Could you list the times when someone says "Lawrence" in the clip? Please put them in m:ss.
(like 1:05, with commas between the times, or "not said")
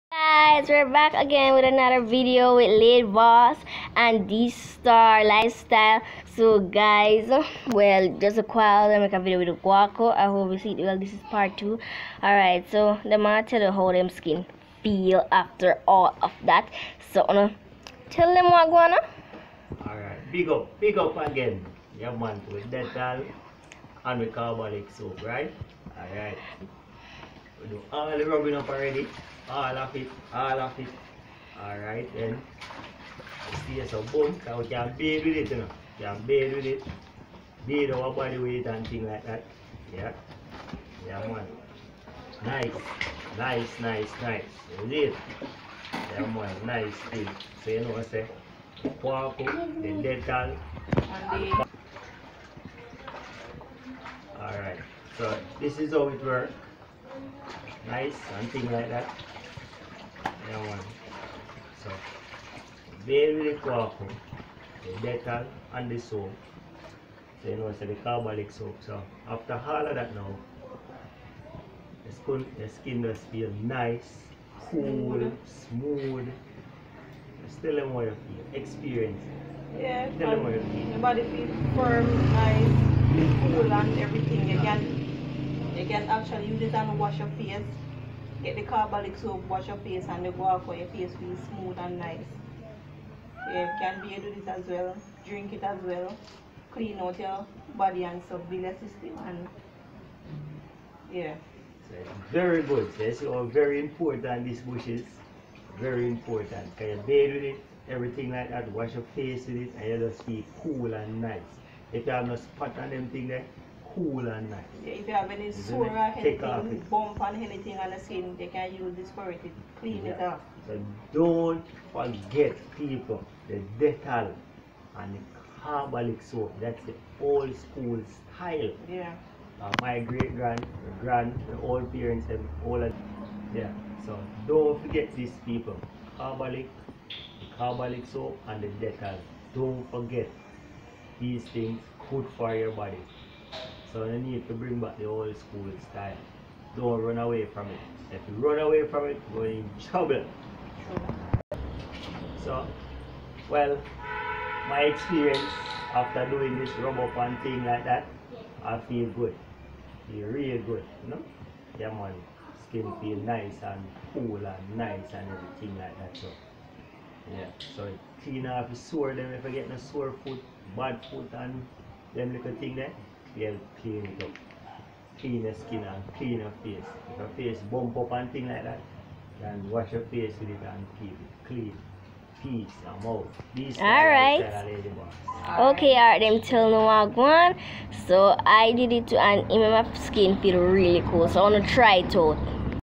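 not said.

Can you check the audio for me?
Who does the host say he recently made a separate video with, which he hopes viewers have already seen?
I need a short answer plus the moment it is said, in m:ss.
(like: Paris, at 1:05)
Guaco, at 0:09.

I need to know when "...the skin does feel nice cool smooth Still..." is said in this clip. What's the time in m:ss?
1:12.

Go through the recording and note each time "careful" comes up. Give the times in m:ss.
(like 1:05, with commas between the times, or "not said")
1:03.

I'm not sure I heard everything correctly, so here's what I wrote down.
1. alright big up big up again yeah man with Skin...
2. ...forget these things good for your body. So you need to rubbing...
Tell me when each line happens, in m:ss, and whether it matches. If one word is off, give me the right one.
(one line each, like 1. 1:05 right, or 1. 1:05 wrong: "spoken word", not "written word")
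1. 0:19 wrong: "Dettol", not "Skin"
2. 2:19 wrong: "bring", not "rubbing".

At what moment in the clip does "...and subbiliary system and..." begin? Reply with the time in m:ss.
1:38.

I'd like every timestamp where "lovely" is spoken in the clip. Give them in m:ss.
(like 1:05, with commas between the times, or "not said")
not said.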